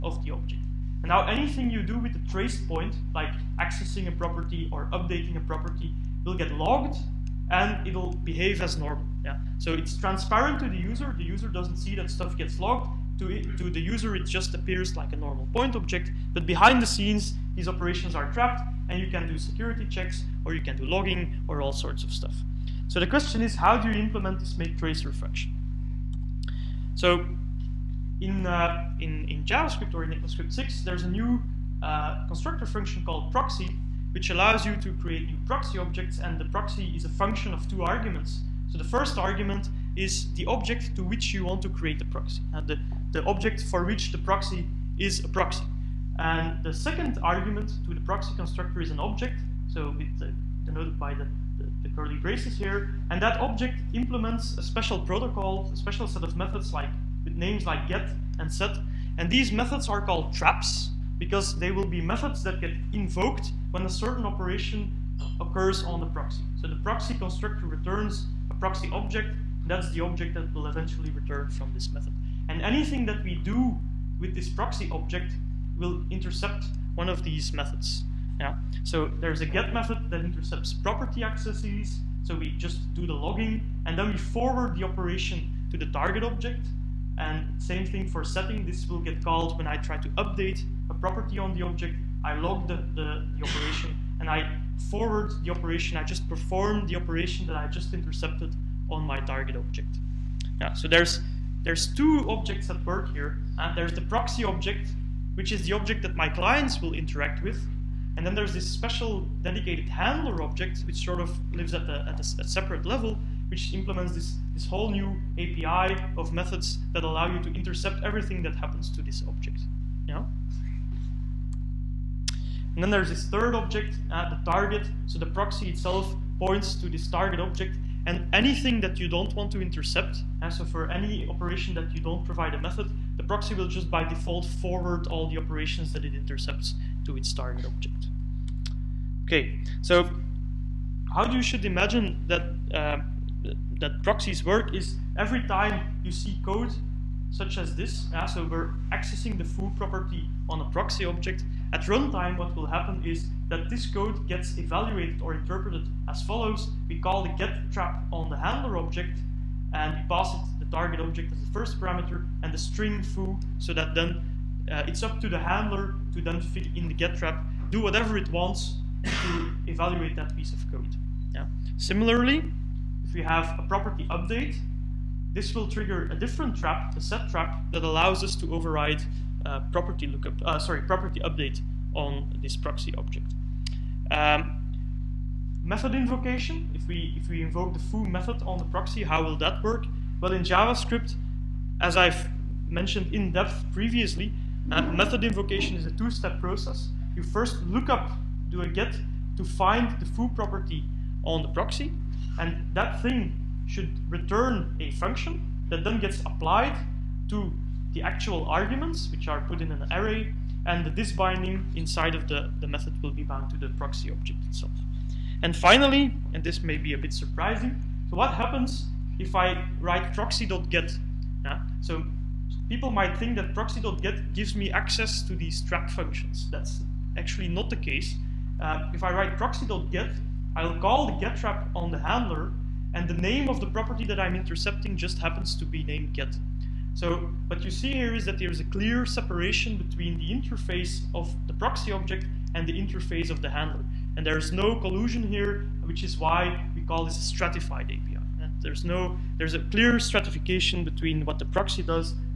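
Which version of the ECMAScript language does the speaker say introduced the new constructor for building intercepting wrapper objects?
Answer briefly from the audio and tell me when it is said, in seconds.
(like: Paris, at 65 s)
ECMAScript 6, at 30 s.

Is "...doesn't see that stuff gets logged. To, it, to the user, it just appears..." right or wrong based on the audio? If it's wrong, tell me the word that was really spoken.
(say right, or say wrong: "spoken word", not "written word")
right.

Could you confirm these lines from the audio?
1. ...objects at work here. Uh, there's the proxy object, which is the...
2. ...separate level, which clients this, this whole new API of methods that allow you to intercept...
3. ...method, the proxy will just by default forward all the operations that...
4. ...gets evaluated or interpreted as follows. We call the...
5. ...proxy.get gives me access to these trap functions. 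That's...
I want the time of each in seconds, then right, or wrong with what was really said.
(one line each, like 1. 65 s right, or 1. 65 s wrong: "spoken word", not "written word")
1. 102 s right
2. 112 s wrong: "implements", not "clients"
3. 132 s right
4. 154 s right
5. 223 s right.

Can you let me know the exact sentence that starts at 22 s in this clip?
So the question is, how do you implement this make tracer reflection?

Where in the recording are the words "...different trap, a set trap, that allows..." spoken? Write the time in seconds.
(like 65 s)
176 s.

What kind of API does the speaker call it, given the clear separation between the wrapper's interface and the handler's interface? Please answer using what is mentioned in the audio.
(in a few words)
stratified API.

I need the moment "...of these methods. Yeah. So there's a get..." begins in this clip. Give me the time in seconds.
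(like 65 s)
77 s.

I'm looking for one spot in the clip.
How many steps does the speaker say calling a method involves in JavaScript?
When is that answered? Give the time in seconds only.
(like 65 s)
195 s.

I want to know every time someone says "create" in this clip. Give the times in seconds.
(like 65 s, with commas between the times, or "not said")
34 s, 41 s.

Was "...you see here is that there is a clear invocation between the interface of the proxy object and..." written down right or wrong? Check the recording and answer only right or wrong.
wrong.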